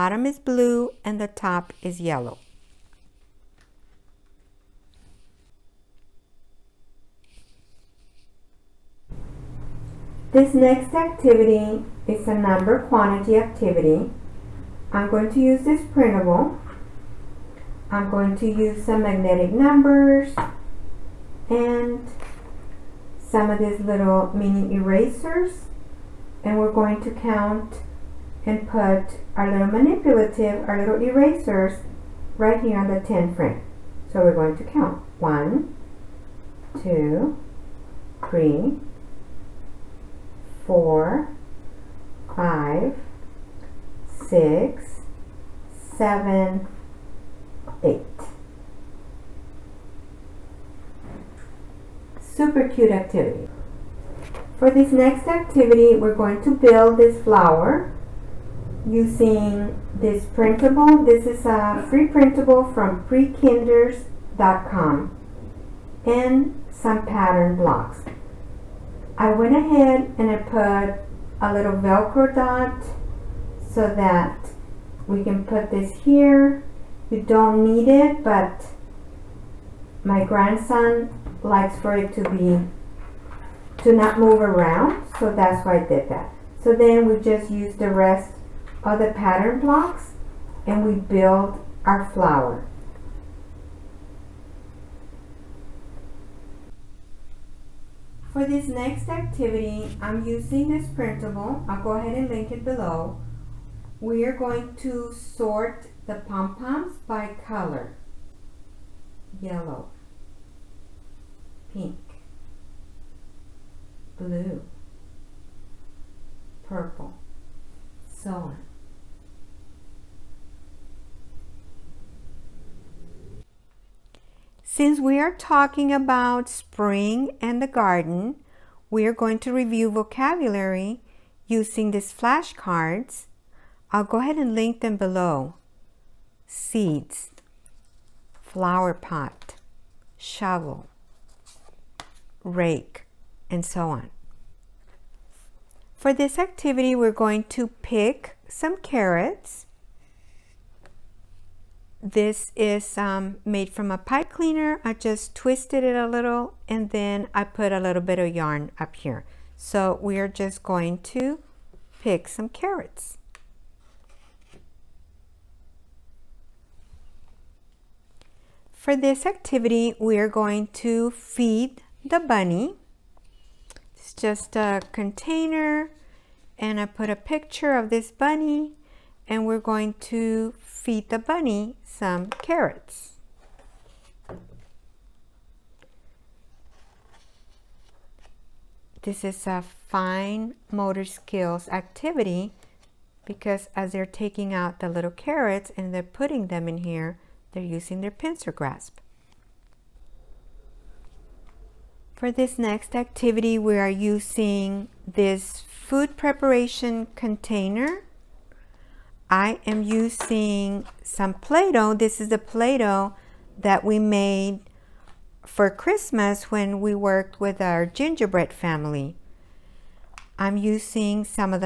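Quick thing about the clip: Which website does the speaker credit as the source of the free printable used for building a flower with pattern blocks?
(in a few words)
prekinders.com.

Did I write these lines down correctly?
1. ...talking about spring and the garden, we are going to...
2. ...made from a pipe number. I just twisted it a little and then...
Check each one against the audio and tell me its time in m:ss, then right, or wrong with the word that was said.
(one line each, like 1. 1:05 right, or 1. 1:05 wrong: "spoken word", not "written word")
1. 2:05 right
2. 2:33 wrong: "cleaner", not "number".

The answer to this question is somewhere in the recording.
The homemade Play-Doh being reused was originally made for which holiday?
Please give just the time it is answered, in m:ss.
3:35.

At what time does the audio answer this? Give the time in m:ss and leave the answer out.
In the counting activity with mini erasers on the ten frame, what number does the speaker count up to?
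0:47.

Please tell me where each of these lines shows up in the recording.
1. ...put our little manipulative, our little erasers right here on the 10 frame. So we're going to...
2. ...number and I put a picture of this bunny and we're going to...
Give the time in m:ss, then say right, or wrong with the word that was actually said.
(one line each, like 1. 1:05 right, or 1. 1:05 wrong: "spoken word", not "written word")
1. 0:28 right
2. 2:54 wrong: "container", not "number".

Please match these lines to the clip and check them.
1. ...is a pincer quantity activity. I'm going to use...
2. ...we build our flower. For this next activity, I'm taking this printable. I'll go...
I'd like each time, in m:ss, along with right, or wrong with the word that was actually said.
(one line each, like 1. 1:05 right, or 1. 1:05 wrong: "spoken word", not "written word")
1. 0:12 wrong: "number", not "pincer"
2. 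1:30 wrong: "using", not "taking".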